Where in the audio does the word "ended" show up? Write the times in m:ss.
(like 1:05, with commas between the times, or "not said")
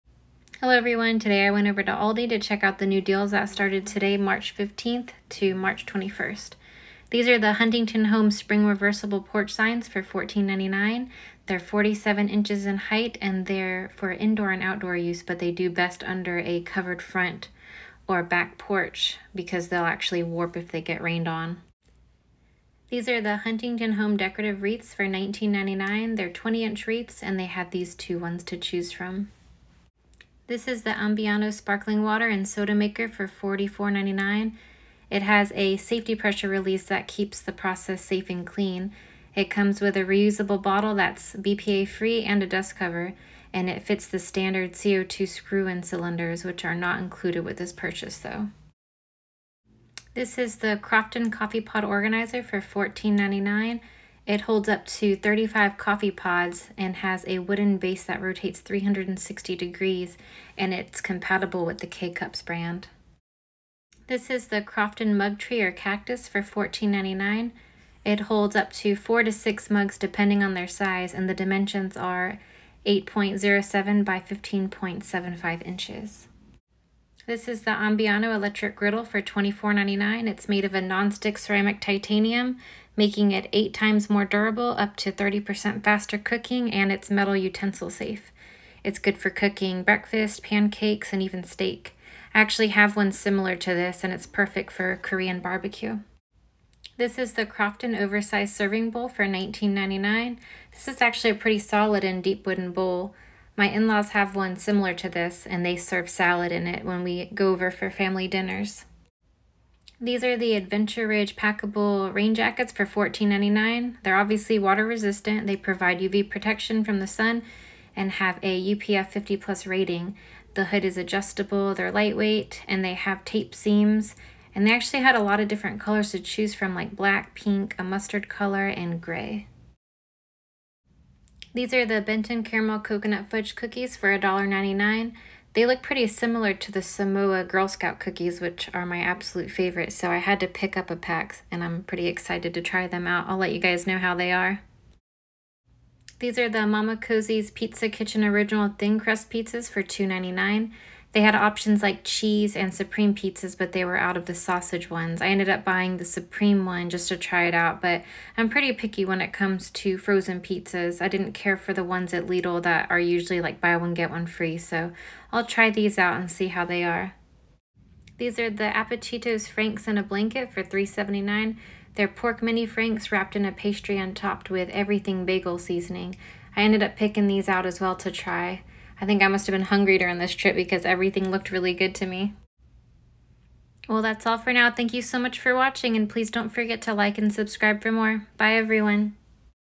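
2:35, 2:56.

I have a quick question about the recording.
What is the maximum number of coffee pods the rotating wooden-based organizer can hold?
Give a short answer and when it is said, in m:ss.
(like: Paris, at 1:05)
35, at 0:55.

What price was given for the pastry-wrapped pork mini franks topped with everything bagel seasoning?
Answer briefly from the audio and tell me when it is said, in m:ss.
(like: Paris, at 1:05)
$3.79, at 2:50.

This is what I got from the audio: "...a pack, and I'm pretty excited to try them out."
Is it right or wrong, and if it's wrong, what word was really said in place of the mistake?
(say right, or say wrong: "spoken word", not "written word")
right.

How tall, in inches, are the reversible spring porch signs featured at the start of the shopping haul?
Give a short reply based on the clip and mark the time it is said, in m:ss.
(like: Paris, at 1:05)
47 inches, at 0:11.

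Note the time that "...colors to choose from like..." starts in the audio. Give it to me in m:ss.
2:05.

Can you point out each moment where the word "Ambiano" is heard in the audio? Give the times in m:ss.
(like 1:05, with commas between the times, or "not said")
0:30, 1:17.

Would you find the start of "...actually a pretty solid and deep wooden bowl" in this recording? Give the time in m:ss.
1:41.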